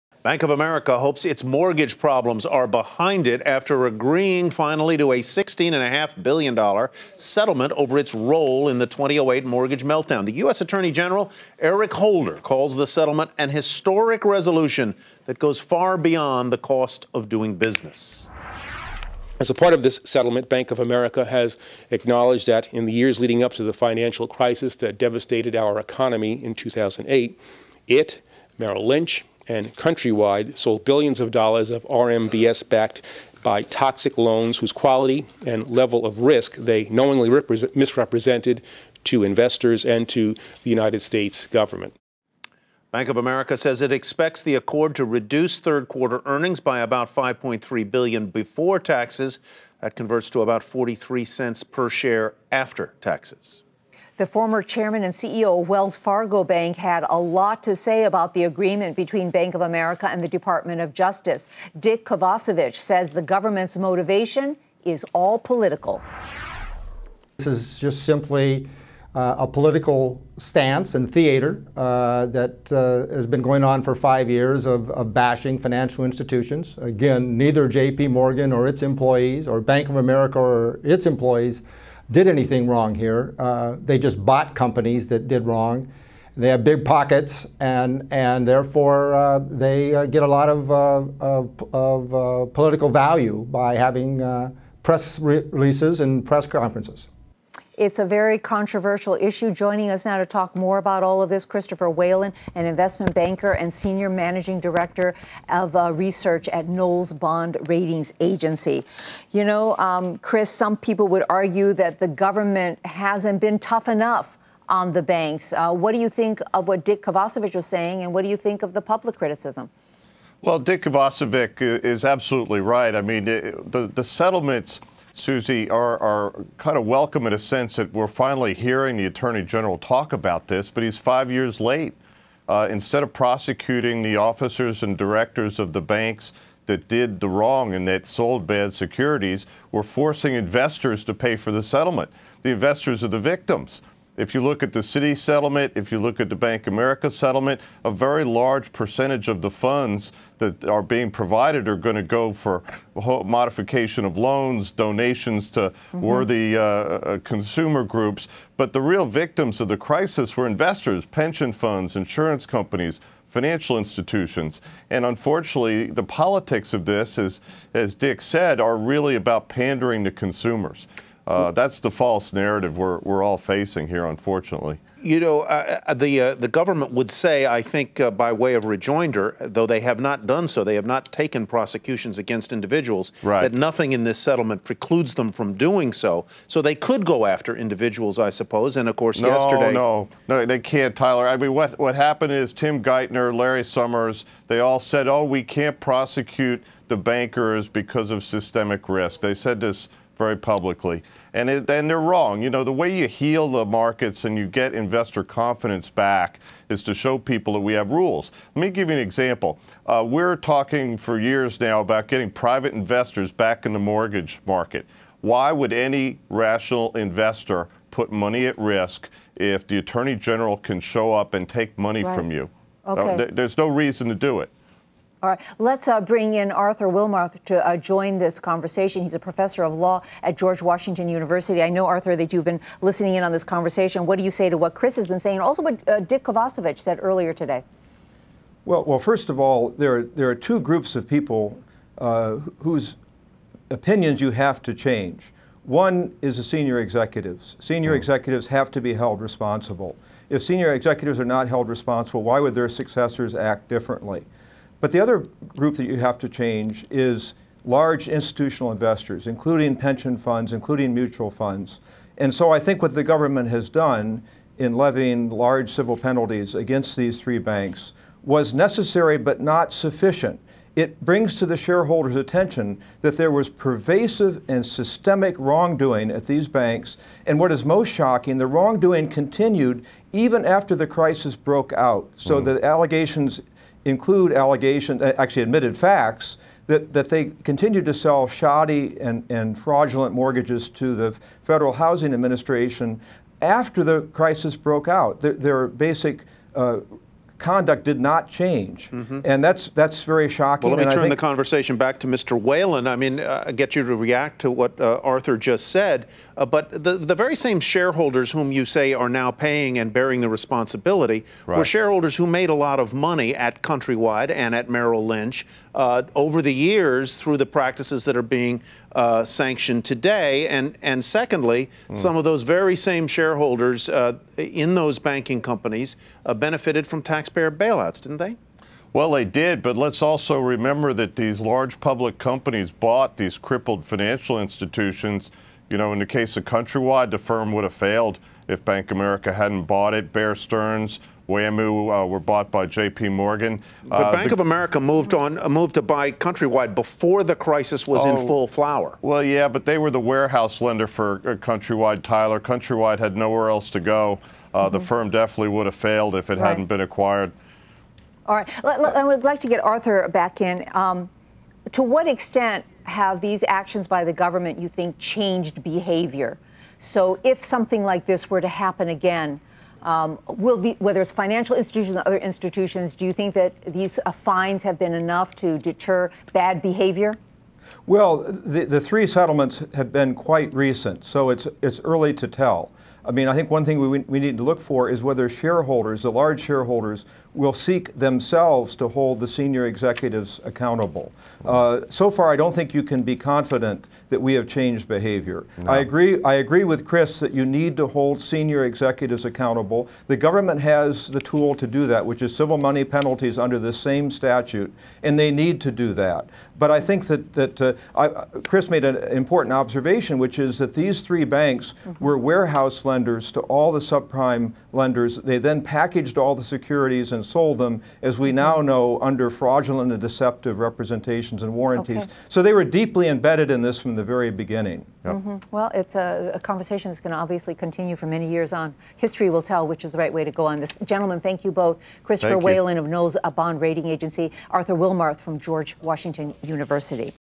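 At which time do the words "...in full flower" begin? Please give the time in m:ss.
5:48.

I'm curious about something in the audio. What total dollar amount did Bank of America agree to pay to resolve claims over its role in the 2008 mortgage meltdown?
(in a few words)
$16.5 billion.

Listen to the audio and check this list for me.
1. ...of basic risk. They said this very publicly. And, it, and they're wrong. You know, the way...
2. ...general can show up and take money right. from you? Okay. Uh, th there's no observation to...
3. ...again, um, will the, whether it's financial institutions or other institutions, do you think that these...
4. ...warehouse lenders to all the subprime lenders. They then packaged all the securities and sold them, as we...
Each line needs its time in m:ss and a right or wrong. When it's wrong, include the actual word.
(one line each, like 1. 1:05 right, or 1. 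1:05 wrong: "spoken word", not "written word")
1. 3:18 wrong: "systemic", not "basic"
2. 3:40 wrong: "reason", not "observation"
3. 6:08 right
4. 6:52 right.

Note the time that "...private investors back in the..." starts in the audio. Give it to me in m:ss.
3:32.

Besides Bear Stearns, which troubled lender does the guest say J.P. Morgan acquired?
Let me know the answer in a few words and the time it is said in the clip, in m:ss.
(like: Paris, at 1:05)
WAMU, at 5:41.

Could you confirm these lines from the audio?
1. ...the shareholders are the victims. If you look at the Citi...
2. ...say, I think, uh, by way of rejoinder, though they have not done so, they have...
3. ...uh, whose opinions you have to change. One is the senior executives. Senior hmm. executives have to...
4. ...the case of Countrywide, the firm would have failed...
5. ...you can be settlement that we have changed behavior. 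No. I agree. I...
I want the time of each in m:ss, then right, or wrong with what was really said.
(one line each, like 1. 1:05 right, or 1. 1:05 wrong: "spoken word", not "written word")
1. 2:22 wrong: "investors", not "shareholders"
2. 2:57 right
3. 4:01 right
4. 5:35 right
5. 6:32 wrong: "confident", not "settlement".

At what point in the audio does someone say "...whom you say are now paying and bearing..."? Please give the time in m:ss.
5:08.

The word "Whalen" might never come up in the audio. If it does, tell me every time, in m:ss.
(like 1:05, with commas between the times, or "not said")
1:41, 5:02, 7:12.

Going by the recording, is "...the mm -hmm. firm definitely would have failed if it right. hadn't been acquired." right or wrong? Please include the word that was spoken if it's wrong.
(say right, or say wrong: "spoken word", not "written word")
right.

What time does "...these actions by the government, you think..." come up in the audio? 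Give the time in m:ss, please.
6:03.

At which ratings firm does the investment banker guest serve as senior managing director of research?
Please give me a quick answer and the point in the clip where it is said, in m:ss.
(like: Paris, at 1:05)
Kroll Bond Ratings Agency, at 1:46.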